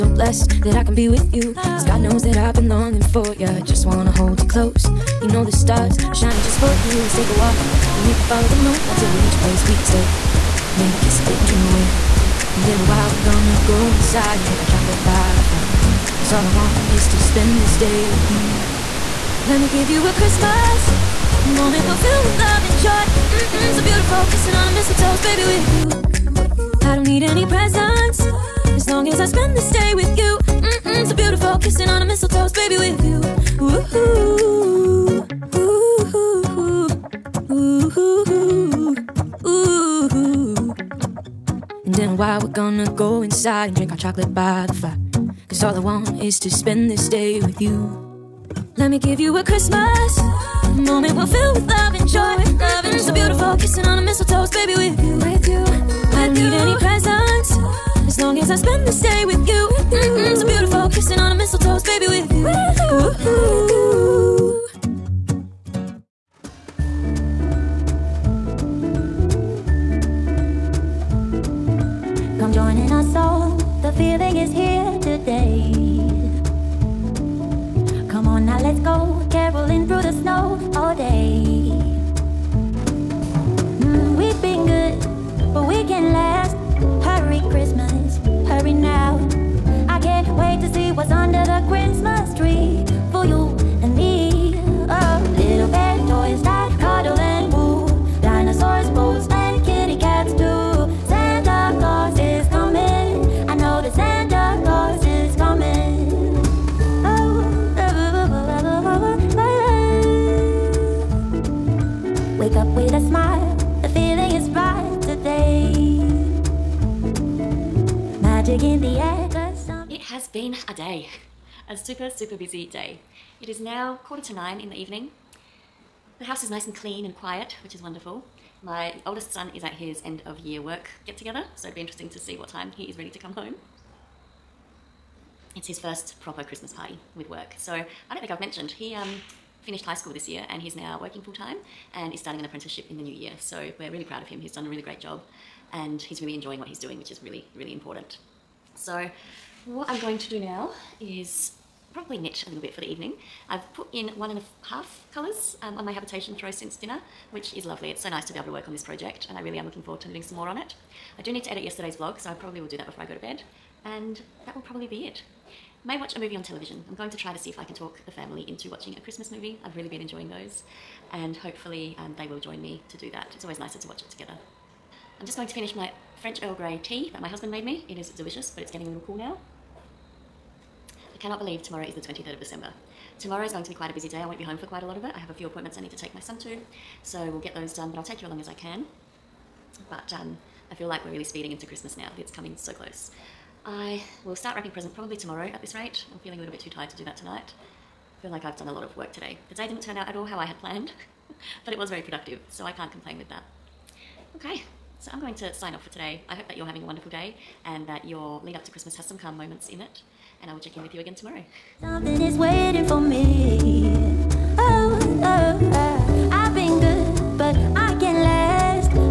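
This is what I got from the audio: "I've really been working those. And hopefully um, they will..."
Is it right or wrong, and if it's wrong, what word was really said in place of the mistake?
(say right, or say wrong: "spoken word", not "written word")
wrong: "enjoying", not "working".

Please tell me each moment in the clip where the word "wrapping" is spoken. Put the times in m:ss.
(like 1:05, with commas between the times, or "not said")
3:14.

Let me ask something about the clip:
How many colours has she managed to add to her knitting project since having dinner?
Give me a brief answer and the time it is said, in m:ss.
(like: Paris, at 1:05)
1.5, at 2:34.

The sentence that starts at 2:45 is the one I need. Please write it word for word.
May watch a movie on television.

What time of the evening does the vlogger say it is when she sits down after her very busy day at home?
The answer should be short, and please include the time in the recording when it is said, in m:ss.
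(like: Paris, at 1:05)
Quarter to nine, at 2:04.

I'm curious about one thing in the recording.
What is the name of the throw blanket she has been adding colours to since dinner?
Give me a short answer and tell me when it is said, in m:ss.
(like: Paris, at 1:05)
Habitation throw, at 2:35.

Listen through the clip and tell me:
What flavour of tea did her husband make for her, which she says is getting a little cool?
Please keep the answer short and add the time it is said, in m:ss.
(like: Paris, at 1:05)
French Earl Grey, at 2:56.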